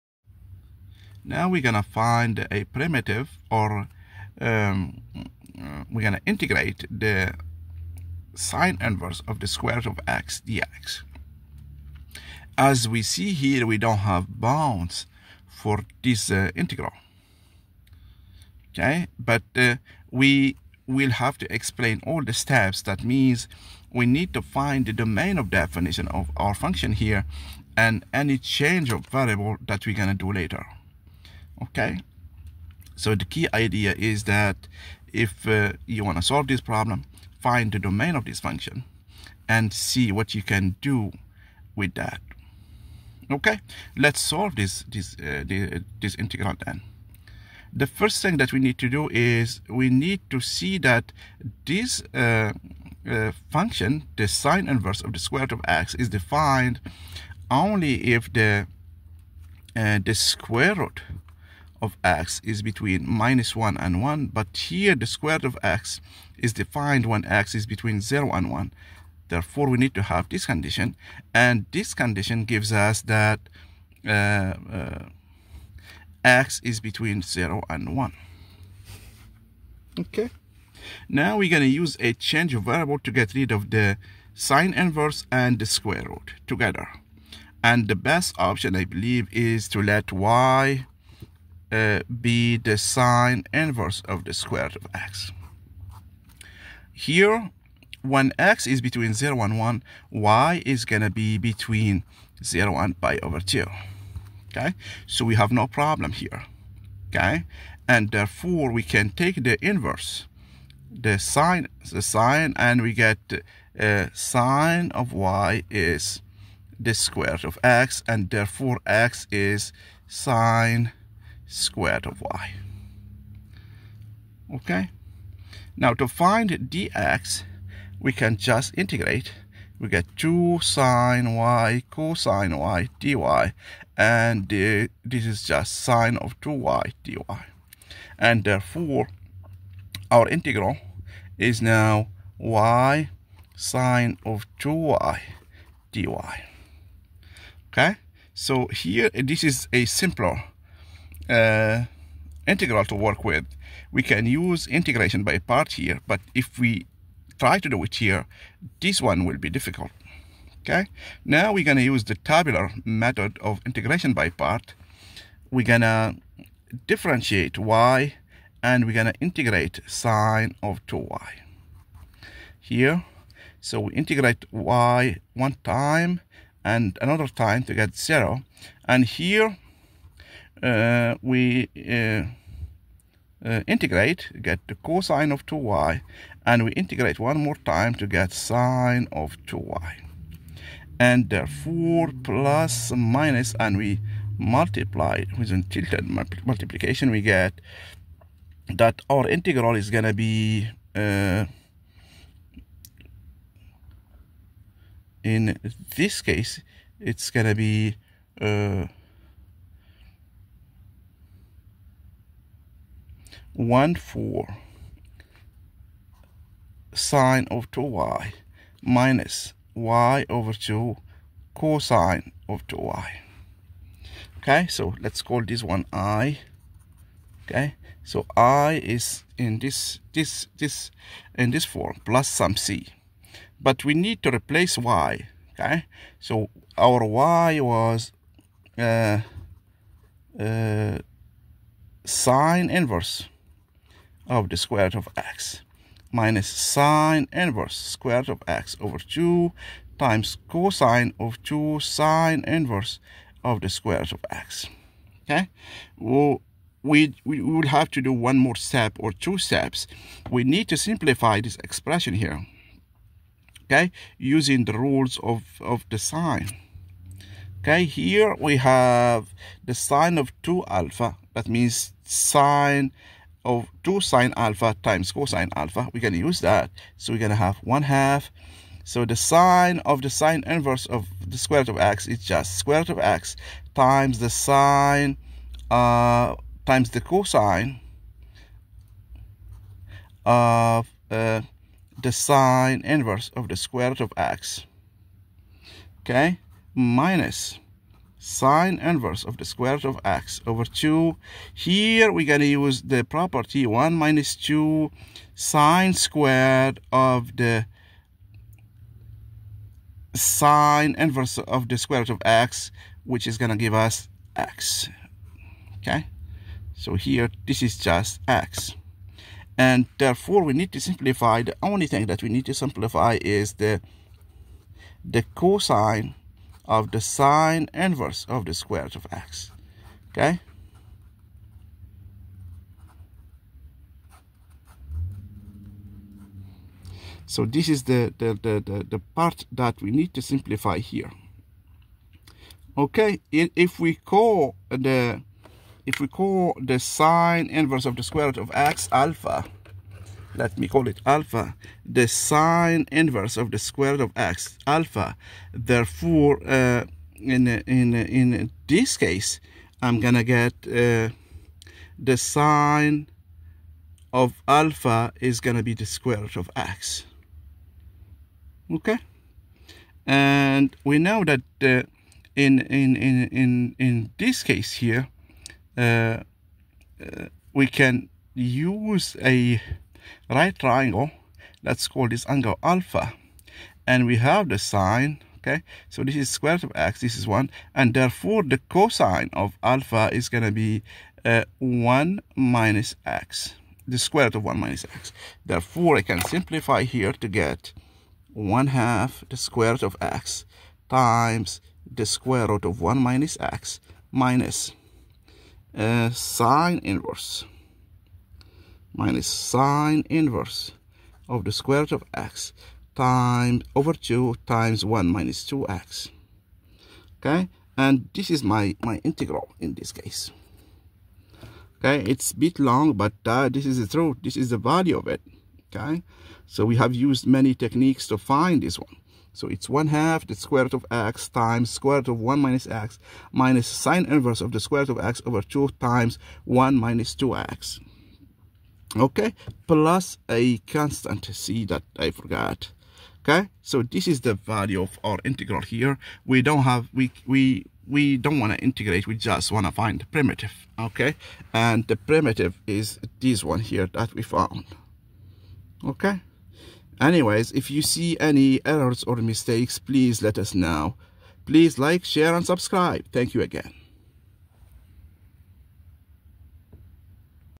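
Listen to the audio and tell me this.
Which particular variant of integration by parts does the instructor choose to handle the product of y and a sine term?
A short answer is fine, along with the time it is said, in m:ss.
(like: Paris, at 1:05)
tabular method, at 2:42.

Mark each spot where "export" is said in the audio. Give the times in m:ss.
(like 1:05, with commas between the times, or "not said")
not said.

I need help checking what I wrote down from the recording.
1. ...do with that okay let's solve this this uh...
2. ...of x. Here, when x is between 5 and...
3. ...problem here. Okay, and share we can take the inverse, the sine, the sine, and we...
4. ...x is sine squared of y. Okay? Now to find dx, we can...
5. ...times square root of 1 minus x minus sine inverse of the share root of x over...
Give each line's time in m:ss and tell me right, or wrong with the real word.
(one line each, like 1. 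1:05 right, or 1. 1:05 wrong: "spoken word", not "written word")
1. 0:40 right
2. 1:34 wrong: "0", not "5"
3. 1:45 wrong: "therefore", not "share"
4. 1:58 right
5. 7:11 wrong: "square", not "share".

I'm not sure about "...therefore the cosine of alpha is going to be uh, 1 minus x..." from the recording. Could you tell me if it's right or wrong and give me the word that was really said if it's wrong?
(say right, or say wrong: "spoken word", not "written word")
right.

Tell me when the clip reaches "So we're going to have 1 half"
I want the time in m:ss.
4:36.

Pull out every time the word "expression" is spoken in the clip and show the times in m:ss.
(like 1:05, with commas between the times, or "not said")
4:21.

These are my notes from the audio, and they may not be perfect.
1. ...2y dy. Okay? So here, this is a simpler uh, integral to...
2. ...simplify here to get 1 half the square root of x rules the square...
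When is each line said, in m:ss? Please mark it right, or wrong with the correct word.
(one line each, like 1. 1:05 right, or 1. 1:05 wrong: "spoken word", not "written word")
1. 2:24 right
2. 6:36 wrong: "times", not "rules".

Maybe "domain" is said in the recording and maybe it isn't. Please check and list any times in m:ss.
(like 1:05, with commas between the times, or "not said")
0:24, 0:37.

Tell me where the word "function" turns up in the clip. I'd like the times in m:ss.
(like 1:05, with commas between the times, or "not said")
0:26, 0:38, 0:53.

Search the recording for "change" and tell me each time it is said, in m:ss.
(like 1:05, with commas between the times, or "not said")
0:28, 1:22.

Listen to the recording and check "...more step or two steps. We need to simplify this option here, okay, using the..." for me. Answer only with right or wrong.
wrong.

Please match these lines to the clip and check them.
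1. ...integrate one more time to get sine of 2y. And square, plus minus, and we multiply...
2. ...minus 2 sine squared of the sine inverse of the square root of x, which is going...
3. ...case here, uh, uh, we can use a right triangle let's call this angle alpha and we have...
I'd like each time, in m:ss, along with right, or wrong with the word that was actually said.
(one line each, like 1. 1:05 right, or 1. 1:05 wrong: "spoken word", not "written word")
1. 3:06 wrong: "therefore", not "square"
2. 5:03 right
3. 6:14 right.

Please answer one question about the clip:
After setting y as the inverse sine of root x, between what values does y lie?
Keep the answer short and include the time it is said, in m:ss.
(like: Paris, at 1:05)
0 and pi/2, at 1:42.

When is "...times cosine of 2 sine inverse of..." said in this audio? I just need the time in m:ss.
4:10.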